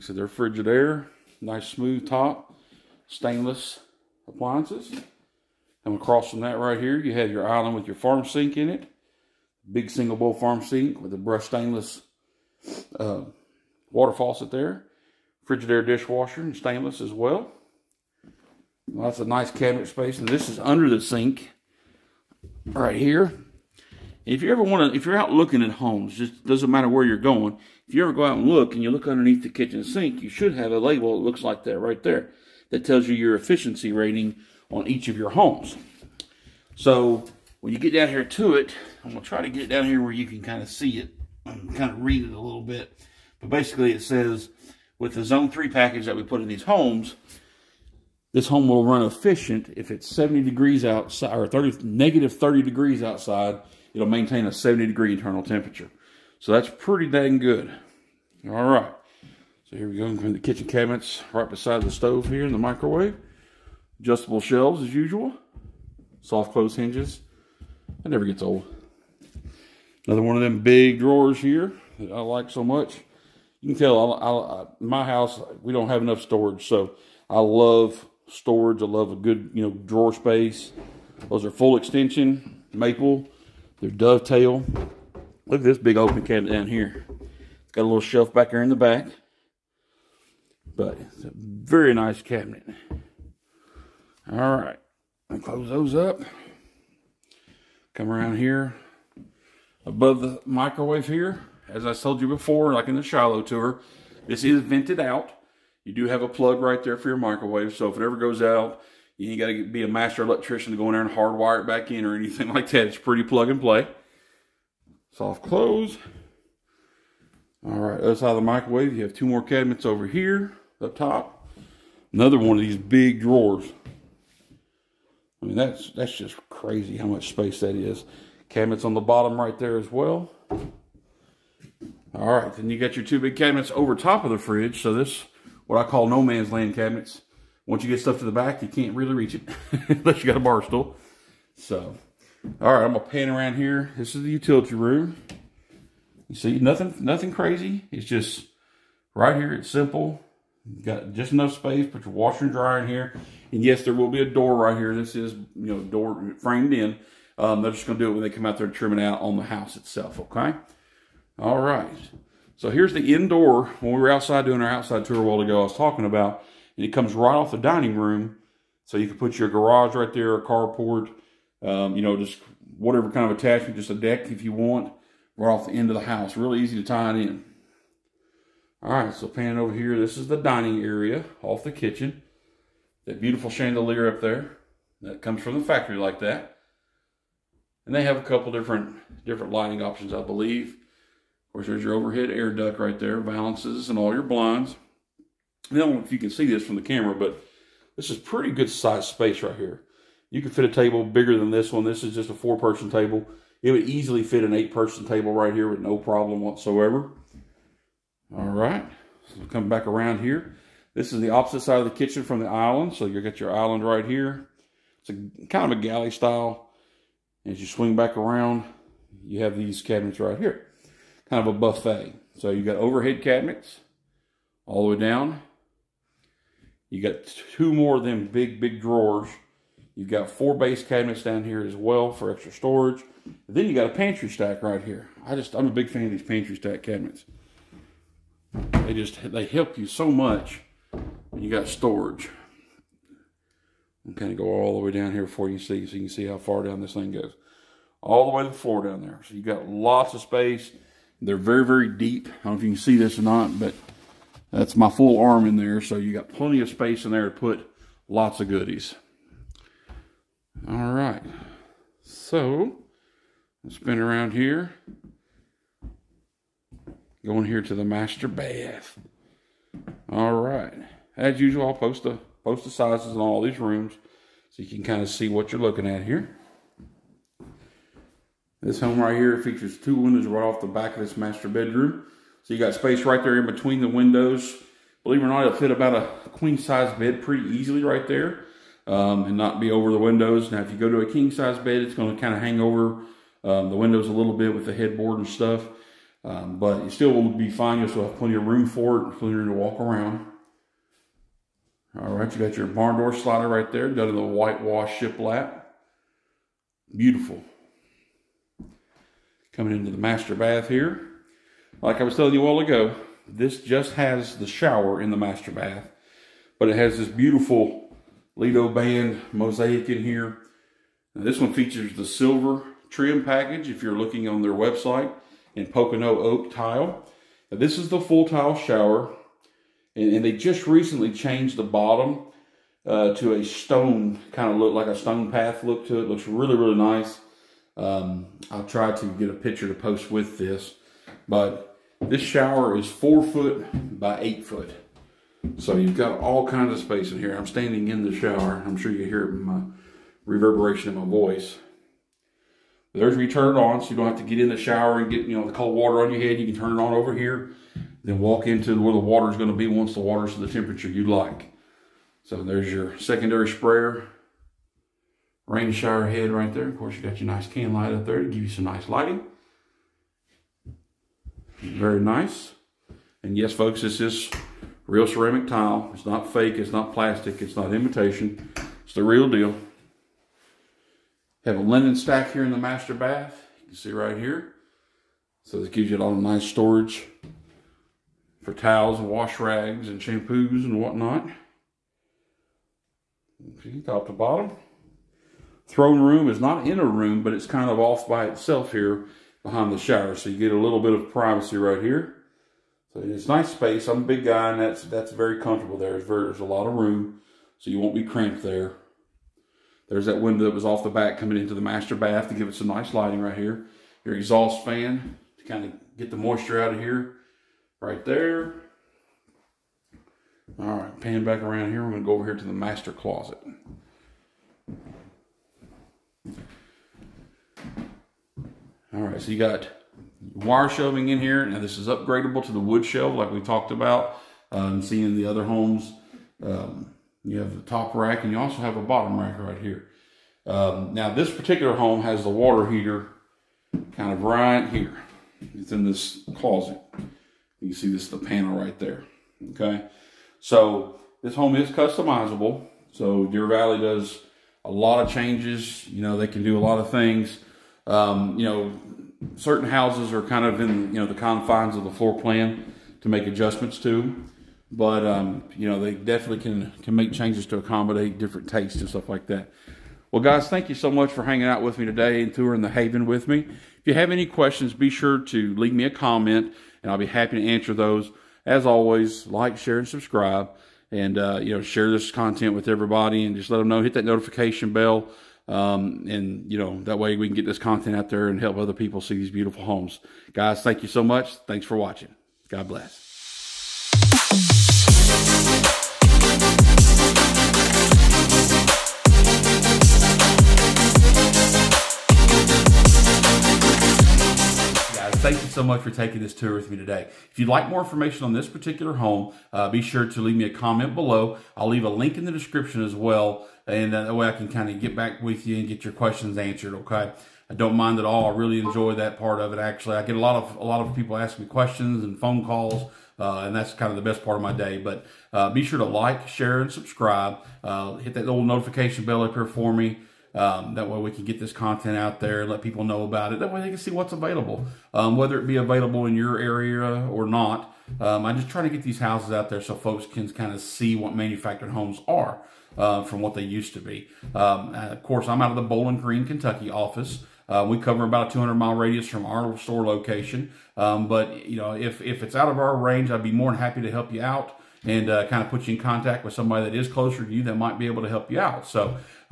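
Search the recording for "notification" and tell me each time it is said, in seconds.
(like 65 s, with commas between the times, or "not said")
484 s, 528 s.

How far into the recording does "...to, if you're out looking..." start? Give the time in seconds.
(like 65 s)
24 s.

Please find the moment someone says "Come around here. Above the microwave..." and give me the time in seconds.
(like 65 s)
97 s.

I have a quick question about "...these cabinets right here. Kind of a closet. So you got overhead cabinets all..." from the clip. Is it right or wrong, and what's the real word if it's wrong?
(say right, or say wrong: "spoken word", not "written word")
wrong: "buffet", not "closet".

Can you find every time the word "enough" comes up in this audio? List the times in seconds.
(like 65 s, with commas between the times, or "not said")
76 s, 151 s.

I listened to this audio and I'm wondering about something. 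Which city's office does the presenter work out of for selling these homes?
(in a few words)
Bowling Green, Kentucky.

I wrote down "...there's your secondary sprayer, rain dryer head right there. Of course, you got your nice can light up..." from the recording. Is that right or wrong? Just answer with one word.
wrong.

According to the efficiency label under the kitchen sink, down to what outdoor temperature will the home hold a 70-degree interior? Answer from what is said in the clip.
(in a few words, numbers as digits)
-30 degrees.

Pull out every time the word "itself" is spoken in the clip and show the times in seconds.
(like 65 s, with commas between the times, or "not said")
159 s, 398 s.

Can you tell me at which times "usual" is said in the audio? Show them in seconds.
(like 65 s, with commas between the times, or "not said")
64 s, 271 s.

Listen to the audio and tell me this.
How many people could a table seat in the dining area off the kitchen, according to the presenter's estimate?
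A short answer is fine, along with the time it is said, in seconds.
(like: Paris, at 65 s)
8, at 204 s.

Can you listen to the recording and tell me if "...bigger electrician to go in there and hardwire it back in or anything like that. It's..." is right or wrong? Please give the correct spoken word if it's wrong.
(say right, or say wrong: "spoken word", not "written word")
wrong: "master", not "bigger".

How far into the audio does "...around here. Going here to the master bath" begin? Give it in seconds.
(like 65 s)
263 s.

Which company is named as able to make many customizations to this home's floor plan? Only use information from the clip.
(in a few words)
Deer Valley.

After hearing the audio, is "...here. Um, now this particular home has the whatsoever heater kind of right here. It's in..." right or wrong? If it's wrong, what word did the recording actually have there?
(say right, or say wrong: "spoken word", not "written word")
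wrong: "water", not "whatsoever".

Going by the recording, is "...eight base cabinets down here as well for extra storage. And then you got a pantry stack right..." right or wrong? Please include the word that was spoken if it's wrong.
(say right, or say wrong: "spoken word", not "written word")
wrong: "four", not "eight".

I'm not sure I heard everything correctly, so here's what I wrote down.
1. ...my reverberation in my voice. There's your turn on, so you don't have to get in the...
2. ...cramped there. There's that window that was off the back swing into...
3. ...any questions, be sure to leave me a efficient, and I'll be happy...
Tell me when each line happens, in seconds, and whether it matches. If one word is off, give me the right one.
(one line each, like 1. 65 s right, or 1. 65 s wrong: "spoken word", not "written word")
1. 349 s right
2. 408 s wrong: "coming", not "swing"
3. 474 s wrong: "comment", not "efficient".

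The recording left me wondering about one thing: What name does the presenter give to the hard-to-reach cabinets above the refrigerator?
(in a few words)
No man's land.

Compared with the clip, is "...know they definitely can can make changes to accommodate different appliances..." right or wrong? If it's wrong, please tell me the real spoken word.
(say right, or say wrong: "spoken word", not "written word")
wrong: "tastes", not "appliances".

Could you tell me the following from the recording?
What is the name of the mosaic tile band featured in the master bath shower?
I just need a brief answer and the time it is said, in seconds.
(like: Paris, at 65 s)
Lido band, at 318 s.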